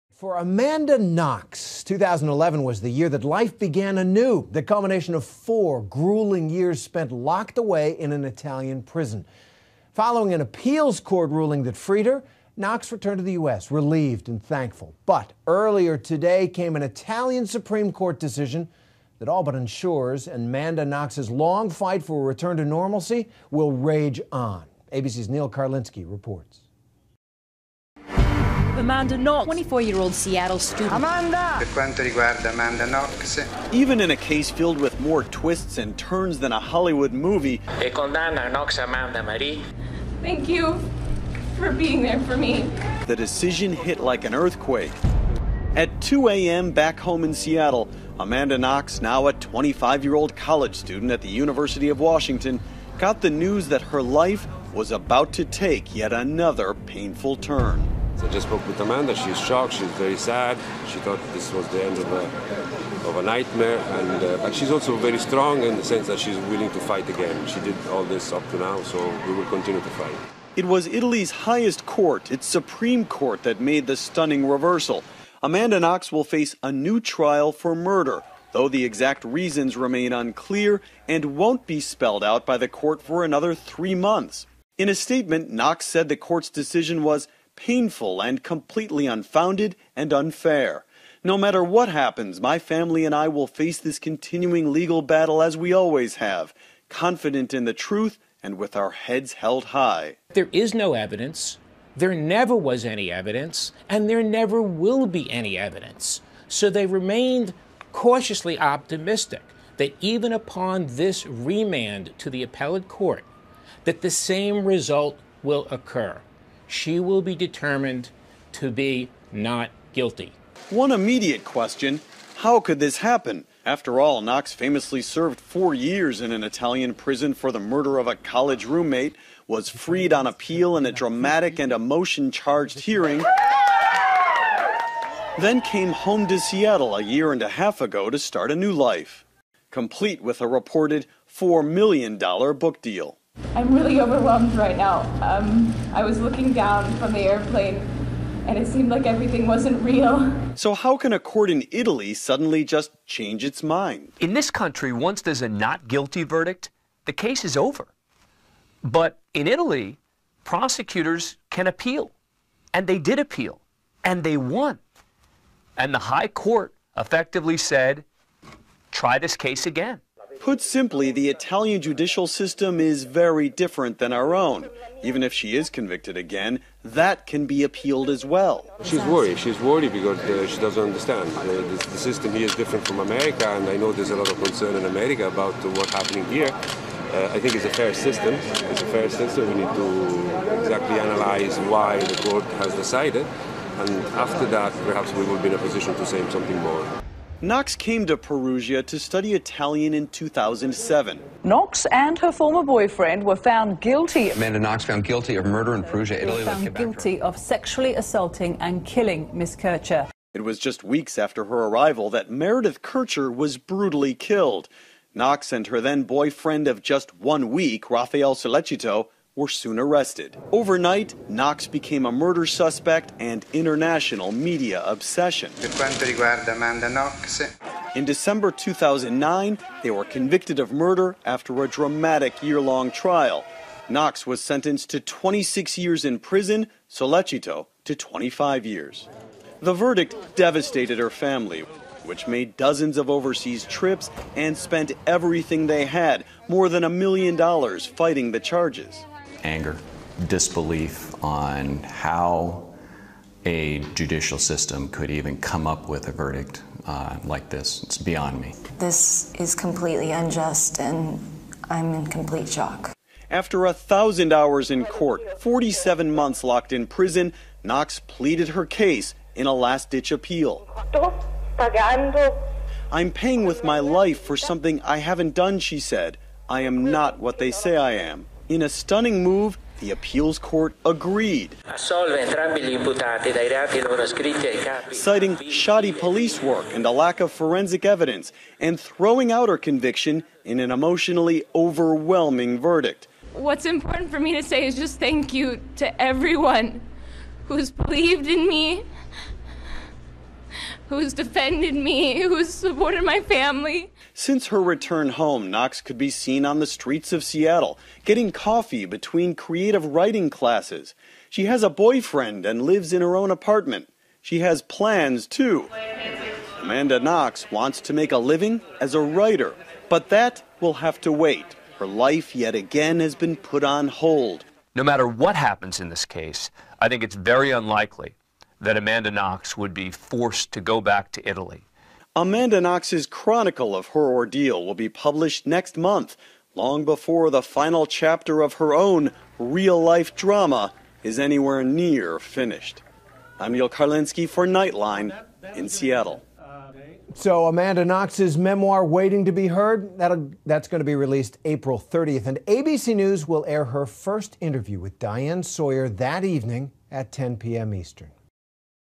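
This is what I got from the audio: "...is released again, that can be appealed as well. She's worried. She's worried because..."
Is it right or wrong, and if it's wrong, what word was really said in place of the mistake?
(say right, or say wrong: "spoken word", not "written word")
wrong: "convicted", not "released".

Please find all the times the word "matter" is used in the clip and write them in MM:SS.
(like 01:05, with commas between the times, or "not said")
01:31, 05:24.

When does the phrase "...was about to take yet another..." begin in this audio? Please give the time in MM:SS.
00:54.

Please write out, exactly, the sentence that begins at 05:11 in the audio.
She has a boyfriend and lives in her own apartment.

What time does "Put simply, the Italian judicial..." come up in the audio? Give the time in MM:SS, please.
02:50.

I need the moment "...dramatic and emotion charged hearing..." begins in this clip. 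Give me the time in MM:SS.
02:10.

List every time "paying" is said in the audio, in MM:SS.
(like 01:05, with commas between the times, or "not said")
04:33.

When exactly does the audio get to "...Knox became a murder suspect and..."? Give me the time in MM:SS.
03:41.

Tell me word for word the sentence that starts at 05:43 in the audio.
I'm Neal Karlinsky for Nightline in Seattle.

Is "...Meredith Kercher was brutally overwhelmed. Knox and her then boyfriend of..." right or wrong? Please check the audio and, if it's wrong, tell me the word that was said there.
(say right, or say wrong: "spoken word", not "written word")
wrong: "killed", not "overwhelmed".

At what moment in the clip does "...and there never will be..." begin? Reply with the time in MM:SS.
01:43.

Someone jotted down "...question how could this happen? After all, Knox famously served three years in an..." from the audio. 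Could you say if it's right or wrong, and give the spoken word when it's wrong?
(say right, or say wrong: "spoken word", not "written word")
wrong: "four", not "three".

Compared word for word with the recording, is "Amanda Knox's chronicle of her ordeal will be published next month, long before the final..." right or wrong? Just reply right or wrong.
right.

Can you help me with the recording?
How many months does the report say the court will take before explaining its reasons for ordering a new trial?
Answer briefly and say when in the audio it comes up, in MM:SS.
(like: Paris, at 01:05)
3 months, at 01:23.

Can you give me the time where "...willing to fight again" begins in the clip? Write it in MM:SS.
01:06.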